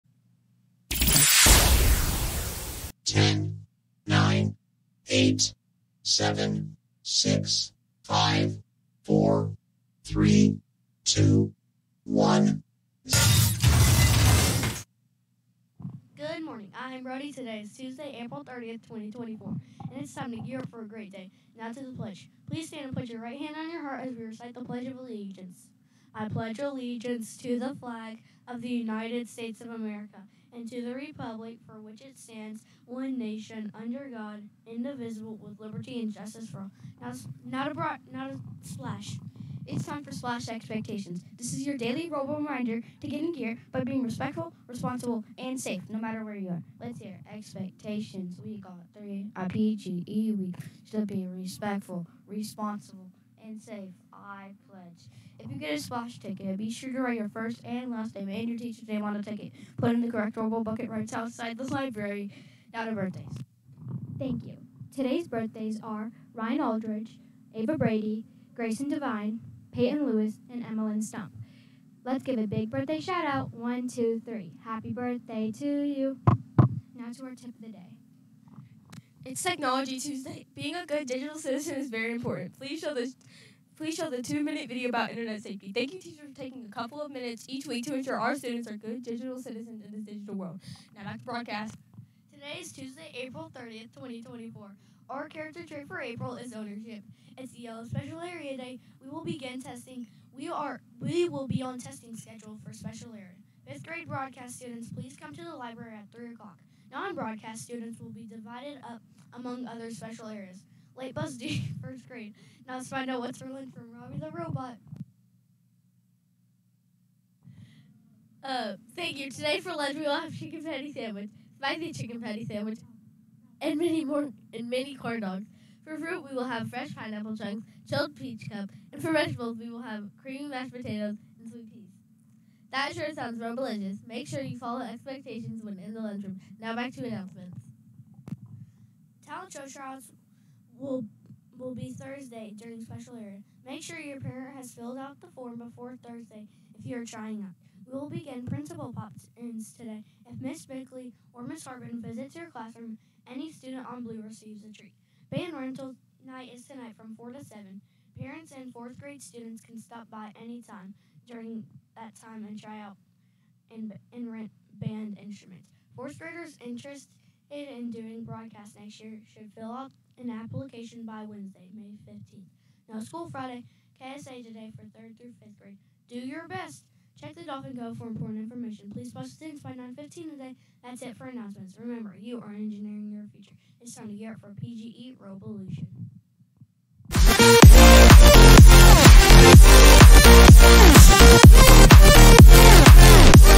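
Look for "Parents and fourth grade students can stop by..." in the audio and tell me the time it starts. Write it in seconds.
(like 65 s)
158 s.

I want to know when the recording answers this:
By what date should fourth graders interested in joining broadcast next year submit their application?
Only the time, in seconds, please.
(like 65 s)
171 s.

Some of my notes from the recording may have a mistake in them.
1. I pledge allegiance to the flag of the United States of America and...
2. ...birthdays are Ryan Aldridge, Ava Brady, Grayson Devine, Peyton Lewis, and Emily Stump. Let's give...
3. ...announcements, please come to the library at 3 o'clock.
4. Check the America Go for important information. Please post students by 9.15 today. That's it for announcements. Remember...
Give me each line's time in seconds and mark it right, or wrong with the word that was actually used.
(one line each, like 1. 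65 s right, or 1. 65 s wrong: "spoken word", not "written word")
1. 26 s right
2. 65 s right
3. 104 s wrong: "students", not "announcements"
4. 177 s wrong: "Dolphin", not "America".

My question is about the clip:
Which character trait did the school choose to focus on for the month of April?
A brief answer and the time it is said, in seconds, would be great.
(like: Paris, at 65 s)
Ownership, at 96 s.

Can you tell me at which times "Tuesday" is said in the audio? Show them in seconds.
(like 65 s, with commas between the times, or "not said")
17 s, 79 s, 92 s.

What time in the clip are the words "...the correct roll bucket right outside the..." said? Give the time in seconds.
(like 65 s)
60 s.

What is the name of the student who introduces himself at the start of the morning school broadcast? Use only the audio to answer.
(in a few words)
Brody.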